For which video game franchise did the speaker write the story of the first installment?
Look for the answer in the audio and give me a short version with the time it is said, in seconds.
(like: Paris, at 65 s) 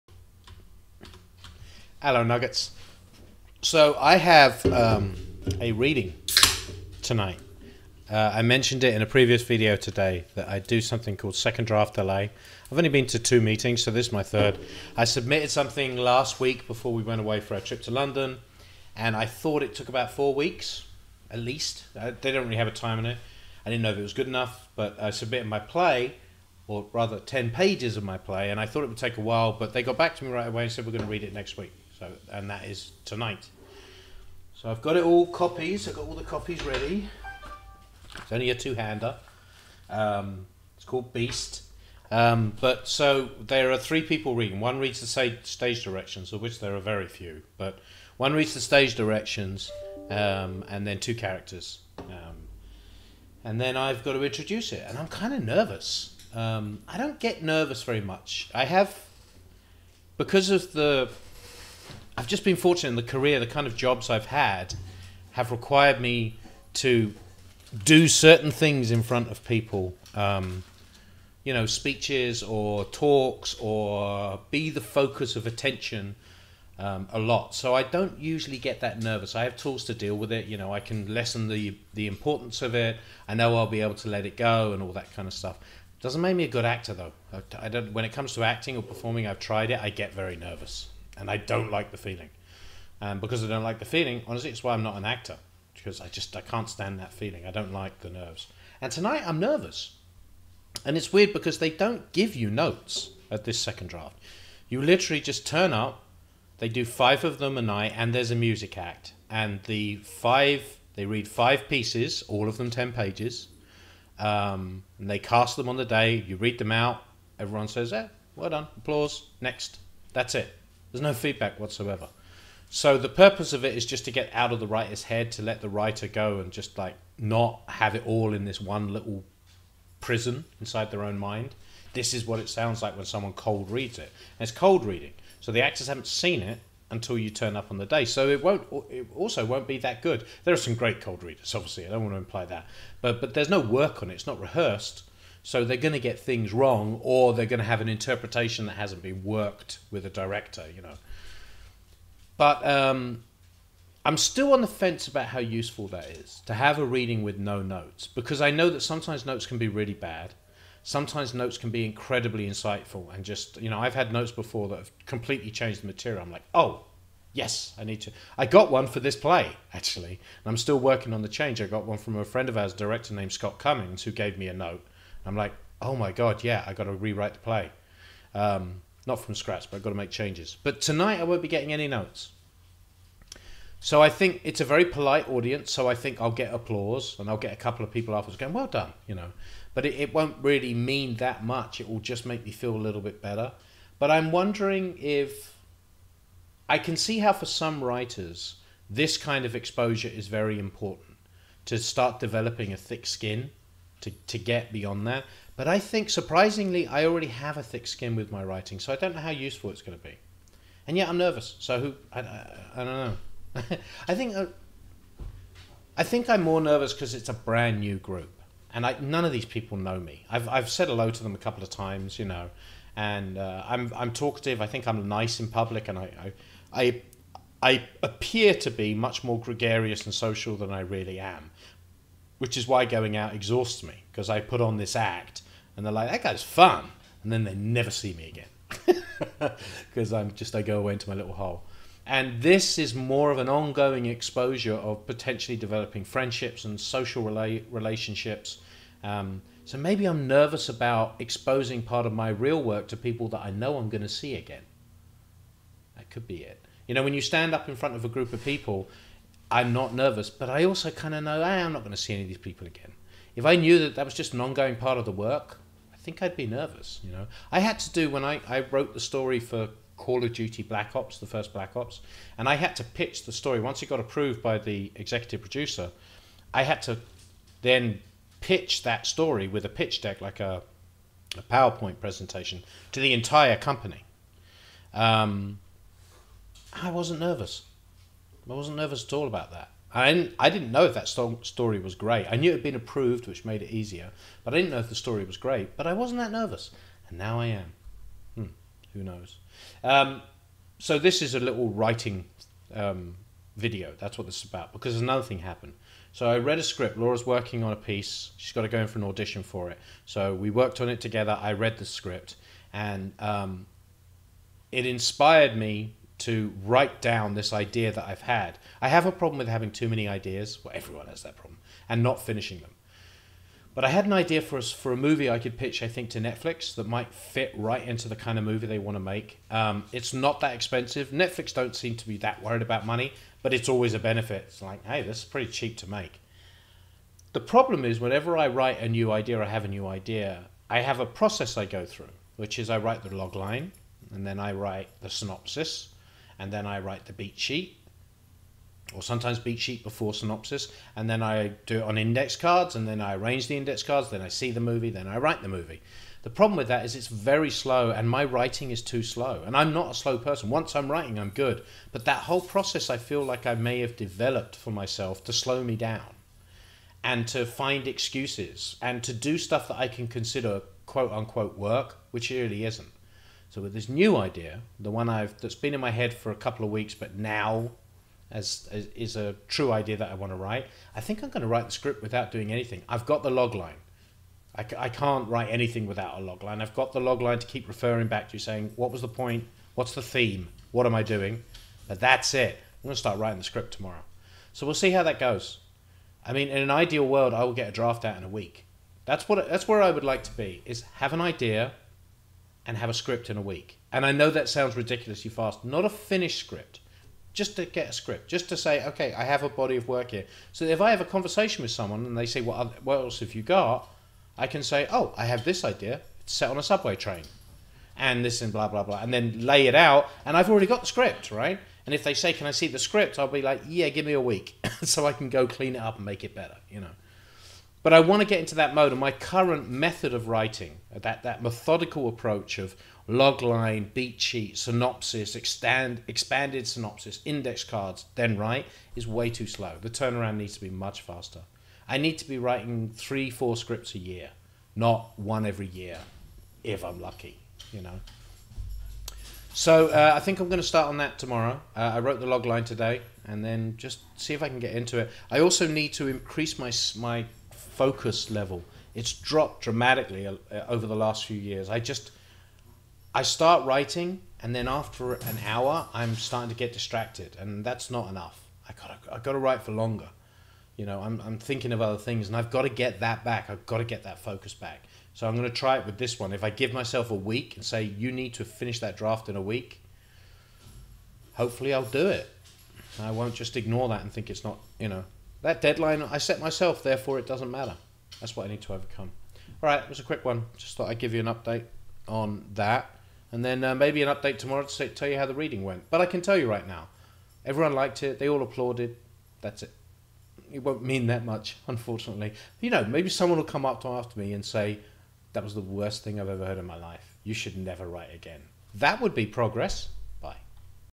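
Call of Duty Black Ops, at 269 s.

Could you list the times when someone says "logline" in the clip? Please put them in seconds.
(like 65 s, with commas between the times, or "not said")
433 s, 452 s.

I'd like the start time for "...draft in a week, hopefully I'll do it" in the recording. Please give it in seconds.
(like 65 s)
478 s.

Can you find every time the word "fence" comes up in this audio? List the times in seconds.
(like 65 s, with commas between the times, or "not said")
154 s.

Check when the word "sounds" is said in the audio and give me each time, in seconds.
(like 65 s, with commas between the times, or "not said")
132 s, 404 s.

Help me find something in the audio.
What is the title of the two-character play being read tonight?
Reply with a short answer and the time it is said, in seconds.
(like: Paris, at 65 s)
Beast, at 41 s.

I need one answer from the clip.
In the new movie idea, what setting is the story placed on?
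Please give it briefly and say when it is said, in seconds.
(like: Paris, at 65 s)
a subway train, at 416 s.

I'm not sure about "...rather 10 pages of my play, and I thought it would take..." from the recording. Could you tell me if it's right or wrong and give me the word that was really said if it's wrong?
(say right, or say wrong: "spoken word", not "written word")
right.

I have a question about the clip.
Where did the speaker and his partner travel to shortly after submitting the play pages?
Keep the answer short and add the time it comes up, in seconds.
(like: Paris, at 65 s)
London, at 17 s.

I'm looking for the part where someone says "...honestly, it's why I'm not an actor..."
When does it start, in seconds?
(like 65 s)
94 s.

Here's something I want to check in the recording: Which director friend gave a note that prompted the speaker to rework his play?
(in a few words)
Scott Cummings.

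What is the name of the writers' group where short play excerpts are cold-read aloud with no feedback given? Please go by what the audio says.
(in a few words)
Second Draft Delay.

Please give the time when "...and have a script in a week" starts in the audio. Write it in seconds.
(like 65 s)
402 s.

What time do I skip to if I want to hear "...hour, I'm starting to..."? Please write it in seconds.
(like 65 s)
465 s.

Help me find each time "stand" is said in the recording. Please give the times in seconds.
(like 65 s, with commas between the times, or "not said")
96 s, 257 s.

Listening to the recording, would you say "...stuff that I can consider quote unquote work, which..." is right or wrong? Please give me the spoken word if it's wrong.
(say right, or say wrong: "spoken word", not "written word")
right.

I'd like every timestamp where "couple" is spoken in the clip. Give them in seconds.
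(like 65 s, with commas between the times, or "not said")
187 s, 221 s, 376 s.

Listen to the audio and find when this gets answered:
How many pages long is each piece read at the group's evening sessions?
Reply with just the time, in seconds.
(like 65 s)
112 s.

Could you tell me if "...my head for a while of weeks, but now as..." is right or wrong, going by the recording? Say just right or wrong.
wrong.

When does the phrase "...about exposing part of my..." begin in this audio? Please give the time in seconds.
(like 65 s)
250 s.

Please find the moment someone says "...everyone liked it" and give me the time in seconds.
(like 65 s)
497 s.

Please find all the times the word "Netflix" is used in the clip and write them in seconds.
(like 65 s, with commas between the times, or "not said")
326 s, 331 s.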